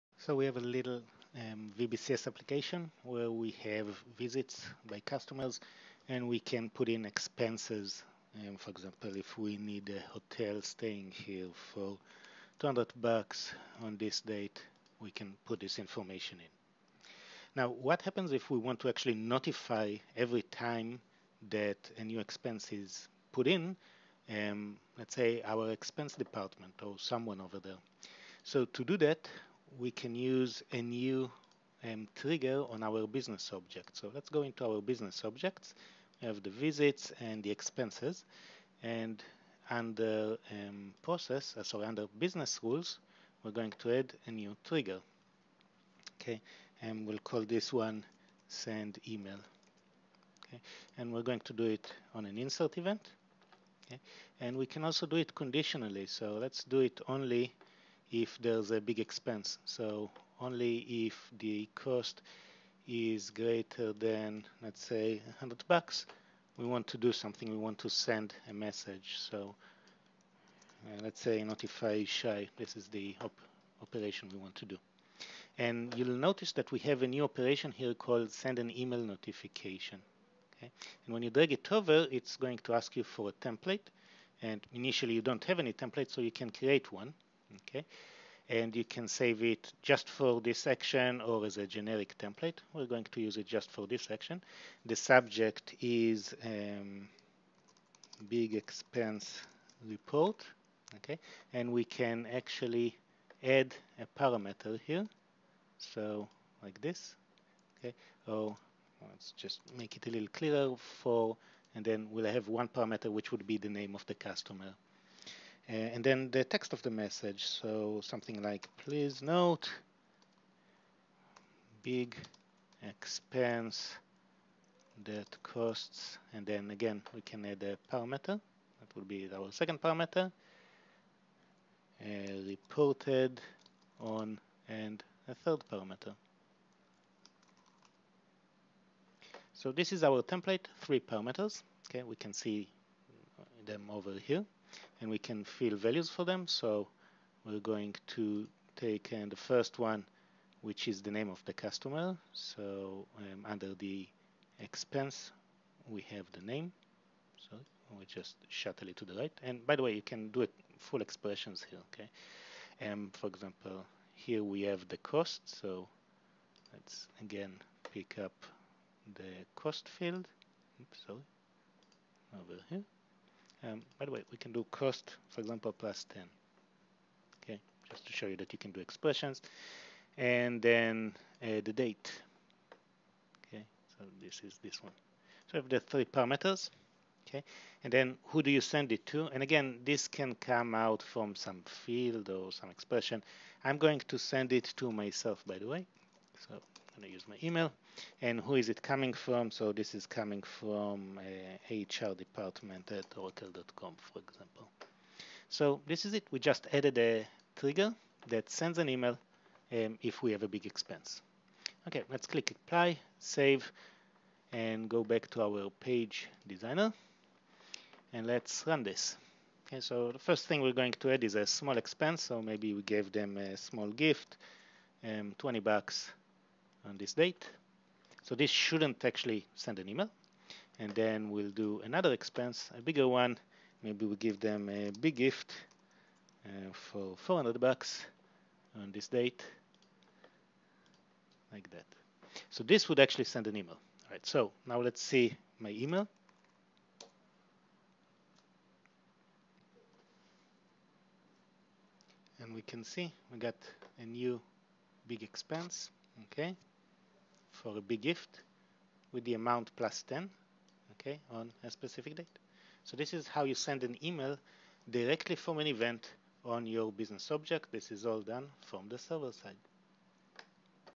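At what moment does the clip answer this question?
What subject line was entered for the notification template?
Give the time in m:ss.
1:38.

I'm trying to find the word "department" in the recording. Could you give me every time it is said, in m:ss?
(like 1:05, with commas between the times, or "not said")
0:26, 3:22.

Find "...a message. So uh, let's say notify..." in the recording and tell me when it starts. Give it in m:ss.
1:08.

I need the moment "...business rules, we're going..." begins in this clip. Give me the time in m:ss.
0:42.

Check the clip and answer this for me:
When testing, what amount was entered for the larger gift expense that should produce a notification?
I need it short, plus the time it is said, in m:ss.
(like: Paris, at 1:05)
400, at 3:57.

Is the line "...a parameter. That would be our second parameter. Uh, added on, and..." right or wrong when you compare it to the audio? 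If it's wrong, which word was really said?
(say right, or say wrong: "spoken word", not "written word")
wrong: "reported", not "added".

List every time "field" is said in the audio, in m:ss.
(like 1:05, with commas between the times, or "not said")
2:49, 3:11.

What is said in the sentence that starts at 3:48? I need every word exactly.
So this shouldn't actually send an email.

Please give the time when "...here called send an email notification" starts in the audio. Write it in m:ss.
1:17.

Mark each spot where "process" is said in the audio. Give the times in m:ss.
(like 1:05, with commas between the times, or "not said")
0:41.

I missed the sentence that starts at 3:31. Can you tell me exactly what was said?
Okay, let's click apply, save, and go back to our page designer.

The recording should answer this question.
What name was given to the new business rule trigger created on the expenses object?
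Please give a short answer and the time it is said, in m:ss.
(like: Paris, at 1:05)
send email, at 0:48.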